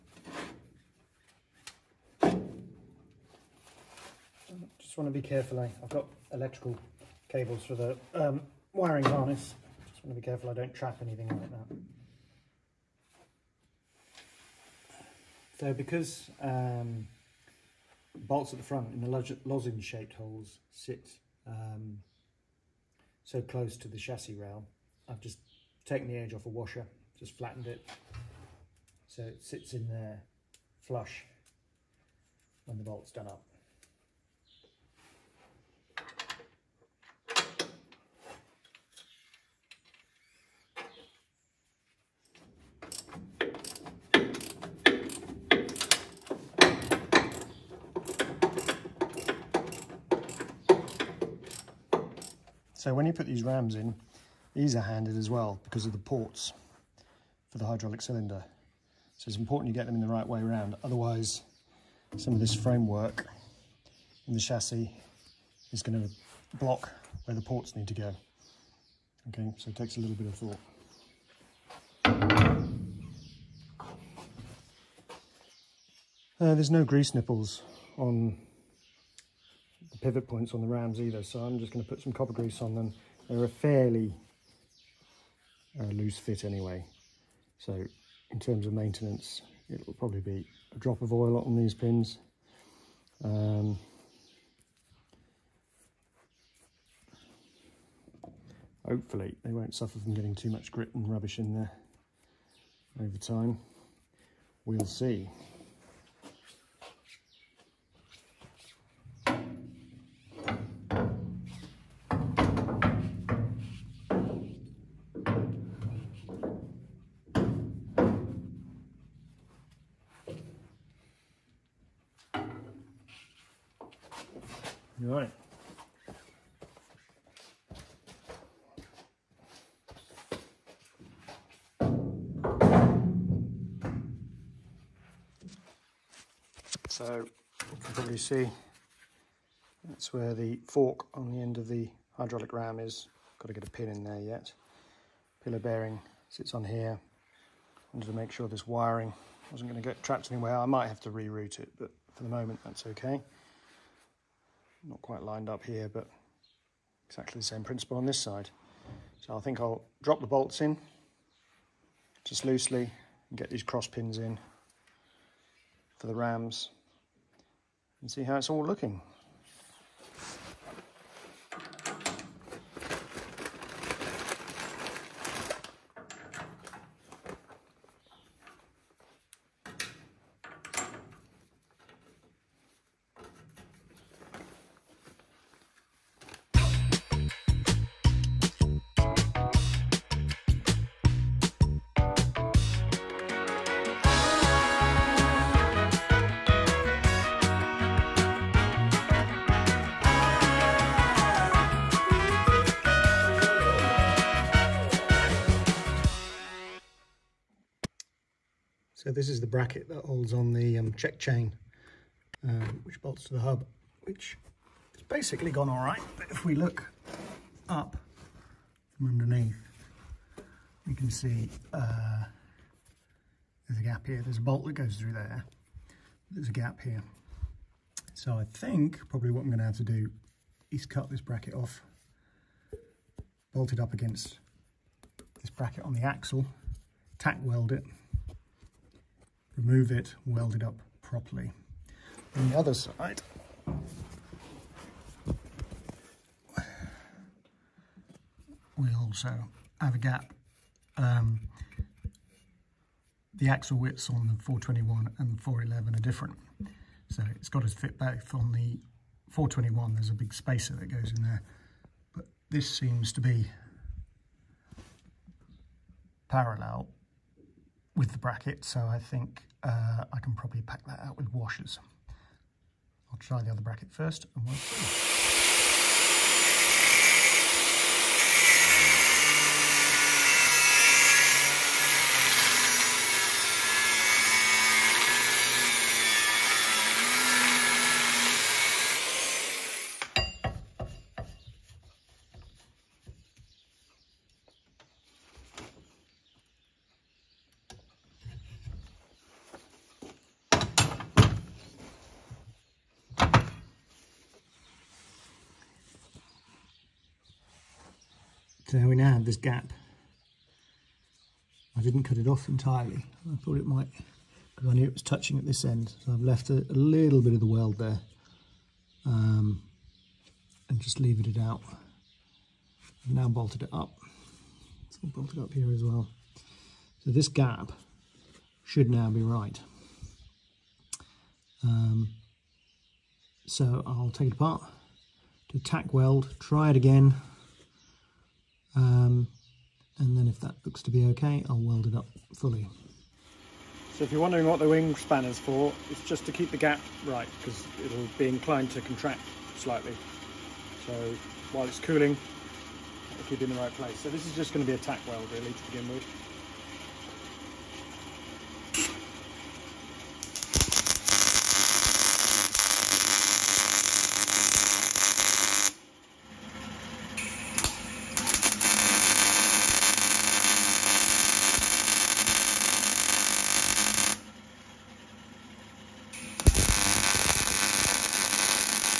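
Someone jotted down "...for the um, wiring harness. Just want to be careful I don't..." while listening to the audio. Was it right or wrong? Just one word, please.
right.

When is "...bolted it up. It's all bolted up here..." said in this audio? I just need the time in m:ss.
5:23.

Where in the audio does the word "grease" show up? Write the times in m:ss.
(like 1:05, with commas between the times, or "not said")
1:16, 1:22.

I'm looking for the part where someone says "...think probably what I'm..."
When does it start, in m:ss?
3:48.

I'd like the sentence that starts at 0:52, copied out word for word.
So when you put these rams in, these are handed as well because of the ports for the hydraulic cylinder.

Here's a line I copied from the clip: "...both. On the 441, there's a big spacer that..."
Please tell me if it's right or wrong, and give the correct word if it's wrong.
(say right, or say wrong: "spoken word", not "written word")
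wrong: "421", not "441".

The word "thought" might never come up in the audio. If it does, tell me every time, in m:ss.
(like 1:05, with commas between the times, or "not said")
1:12, 5:13.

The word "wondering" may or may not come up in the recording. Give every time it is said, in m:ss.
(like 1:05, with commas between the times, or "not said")
5:44.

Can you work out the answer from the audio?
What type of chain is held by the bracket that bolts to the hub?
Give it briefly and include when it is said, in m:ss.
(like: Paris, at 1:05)
Check chain, at 3:30.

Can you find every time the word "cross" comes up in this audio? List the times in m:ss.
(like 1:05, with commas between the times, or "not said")
2:43.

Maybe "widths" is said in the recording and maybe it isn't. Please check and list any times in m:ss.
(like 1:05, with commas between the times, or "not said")
4:13.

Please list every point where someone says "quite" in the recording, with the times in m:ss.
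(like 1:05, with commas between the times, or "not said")
2:35.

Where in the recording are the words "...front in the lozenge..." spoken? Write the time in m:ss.
0:18.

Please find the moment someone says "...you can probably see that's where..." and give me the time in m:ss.
2:17.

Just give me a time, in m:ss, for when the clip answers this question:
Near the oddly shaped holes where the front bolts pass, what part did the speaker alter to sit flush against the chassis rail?
0:26.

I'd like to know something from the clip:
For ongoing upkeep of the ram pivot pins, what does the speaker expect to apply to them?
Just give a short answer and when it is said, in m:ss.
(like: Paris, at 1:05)
A drop of oil, at 1:30.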